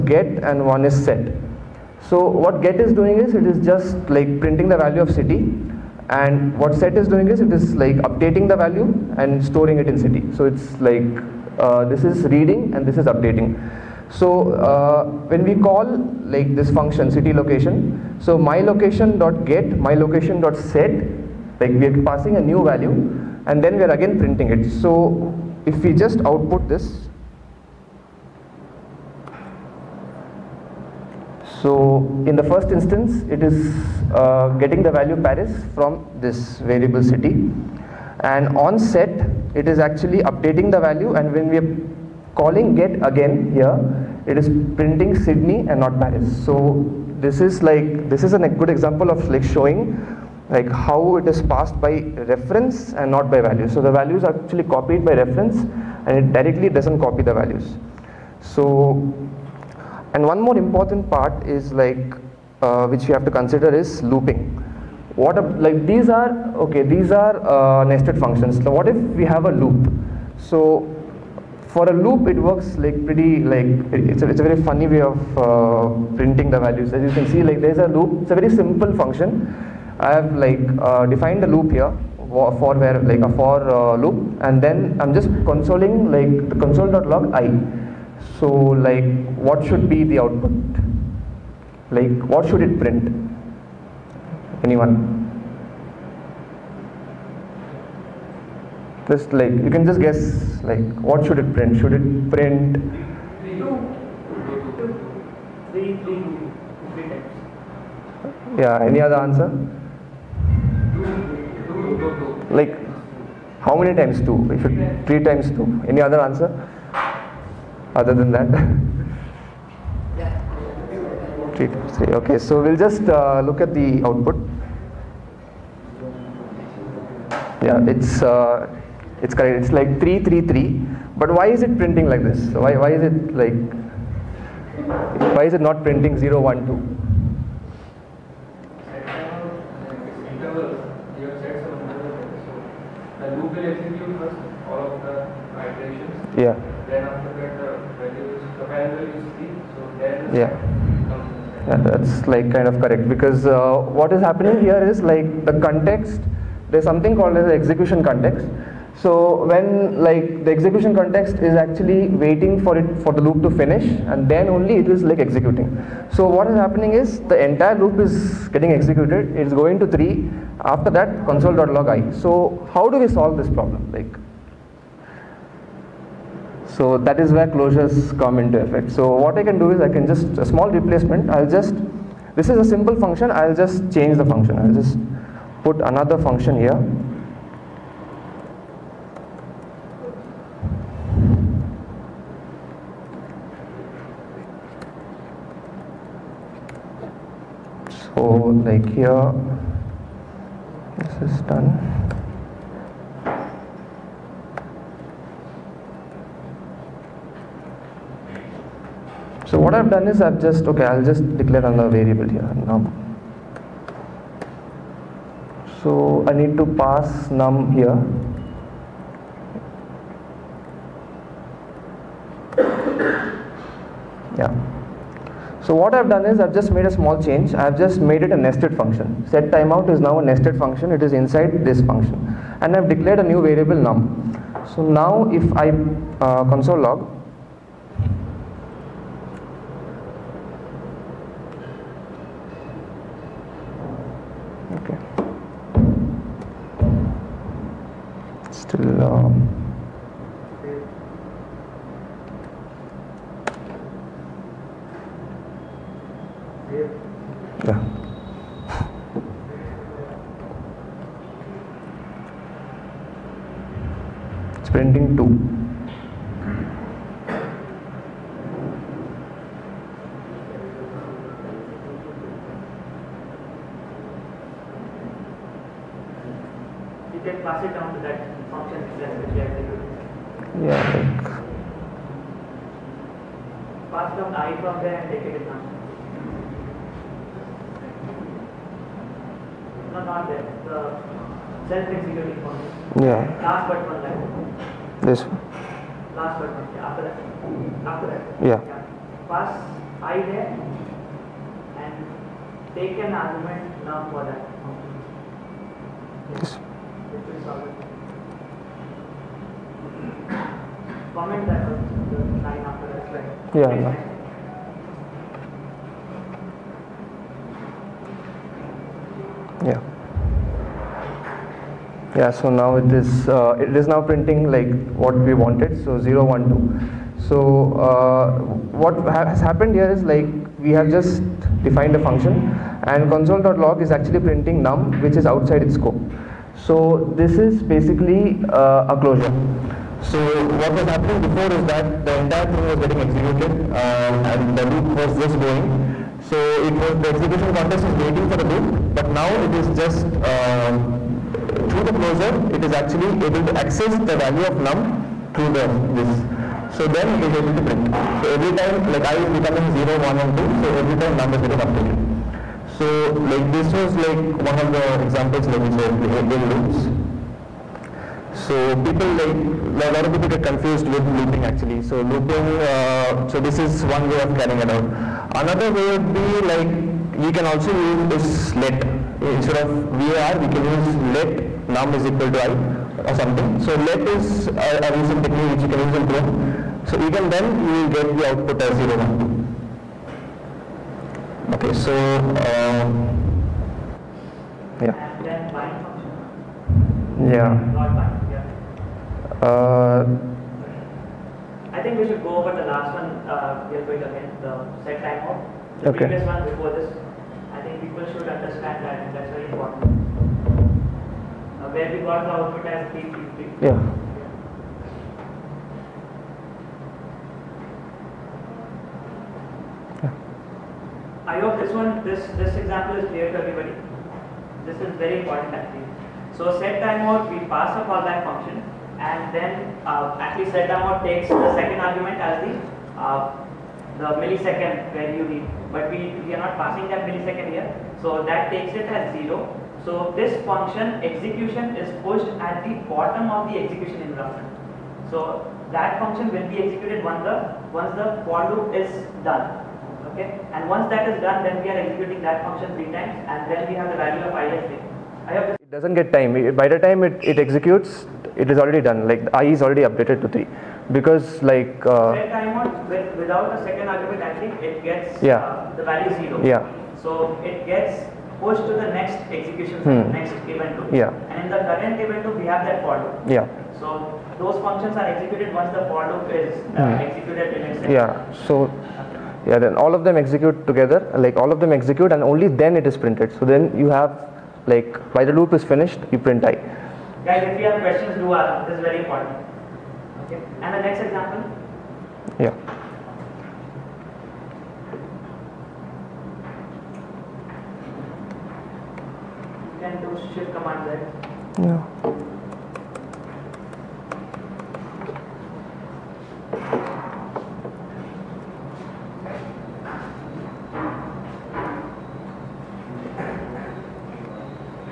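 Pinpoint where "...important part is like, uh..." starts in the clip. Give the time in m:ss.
1:00.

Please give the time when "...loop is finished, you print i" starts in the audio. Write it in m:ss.
8:05.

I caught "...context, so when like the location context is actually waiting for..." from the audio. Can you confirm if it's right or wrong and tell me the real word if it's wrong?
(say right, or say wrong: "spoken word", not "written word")
wrong: "execution", not "location".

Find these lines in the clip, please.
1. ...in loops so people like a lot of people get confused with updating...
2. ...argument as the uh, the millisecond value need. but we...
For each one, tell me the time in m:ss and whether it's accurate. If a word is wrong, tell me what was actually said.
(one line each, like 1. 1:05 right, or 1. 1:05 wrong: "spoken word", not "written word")
1. 6:06 wrong: "looping", not "updating"
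2. 7:11 right.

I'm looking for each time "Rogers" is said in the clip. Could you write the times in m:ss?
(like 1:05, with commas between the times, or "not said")
not said.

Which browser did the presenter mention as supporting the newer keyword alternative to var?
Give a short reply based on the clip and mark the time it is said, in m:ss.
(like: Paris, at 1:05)
Chrome, at 6:26.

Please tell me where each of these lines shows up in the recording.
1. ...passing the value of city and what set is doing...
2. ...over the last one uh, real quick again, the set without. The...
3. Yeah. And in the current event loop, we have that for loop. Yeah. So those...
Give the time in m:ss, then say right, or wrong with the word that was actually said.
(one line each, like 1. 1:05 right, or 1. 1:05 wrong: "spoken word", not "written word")
1. 0:04 wrong: "printing", not "passing"
2. 6:42 wrong: "timeout", not "without"
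3. 7:50 right.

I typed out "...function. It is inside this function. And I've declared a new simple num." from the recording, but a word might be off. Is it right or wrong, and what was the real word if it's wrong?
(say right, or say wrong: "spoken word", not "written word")
wrong: "variable", not "simple".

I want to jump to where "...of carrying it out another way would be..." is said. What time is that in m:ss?
6:14.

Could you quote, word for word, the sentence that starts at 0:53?
So the values are actually copied by reference and it directly doesn't copy the values.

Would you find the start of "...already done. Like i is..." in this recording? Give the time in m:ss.
7:38.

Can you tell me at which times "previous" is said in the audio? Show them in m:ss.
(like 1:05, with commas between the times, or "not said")
6:46.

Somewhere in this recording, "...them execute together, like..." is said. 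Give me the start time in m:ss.
8:00.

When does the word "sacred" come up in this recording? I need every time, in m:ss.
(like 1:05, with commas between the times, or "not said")
not said.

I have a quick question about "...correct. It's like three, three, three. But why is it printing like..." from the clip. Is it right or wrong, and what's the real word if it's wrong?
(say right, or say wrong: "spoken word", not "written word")
right.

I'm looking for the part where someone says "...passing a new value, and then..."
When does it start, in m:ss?
0:22.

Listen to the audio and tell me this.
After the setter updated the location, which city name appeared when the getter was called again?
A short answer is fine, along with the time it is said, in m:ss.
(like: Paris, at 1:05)
Sydney, at 0:45.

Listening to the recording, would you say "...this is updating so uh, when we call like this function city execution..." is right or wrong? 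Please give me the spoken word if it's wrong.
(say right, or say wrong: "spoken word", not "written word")
wrong: "location", not "execution".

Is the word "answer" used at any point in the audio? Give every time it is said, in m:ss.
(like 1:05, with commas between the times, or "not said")
1:49, 1:56.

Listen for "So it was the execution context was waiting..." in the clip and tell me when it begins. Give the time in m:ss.
5:46.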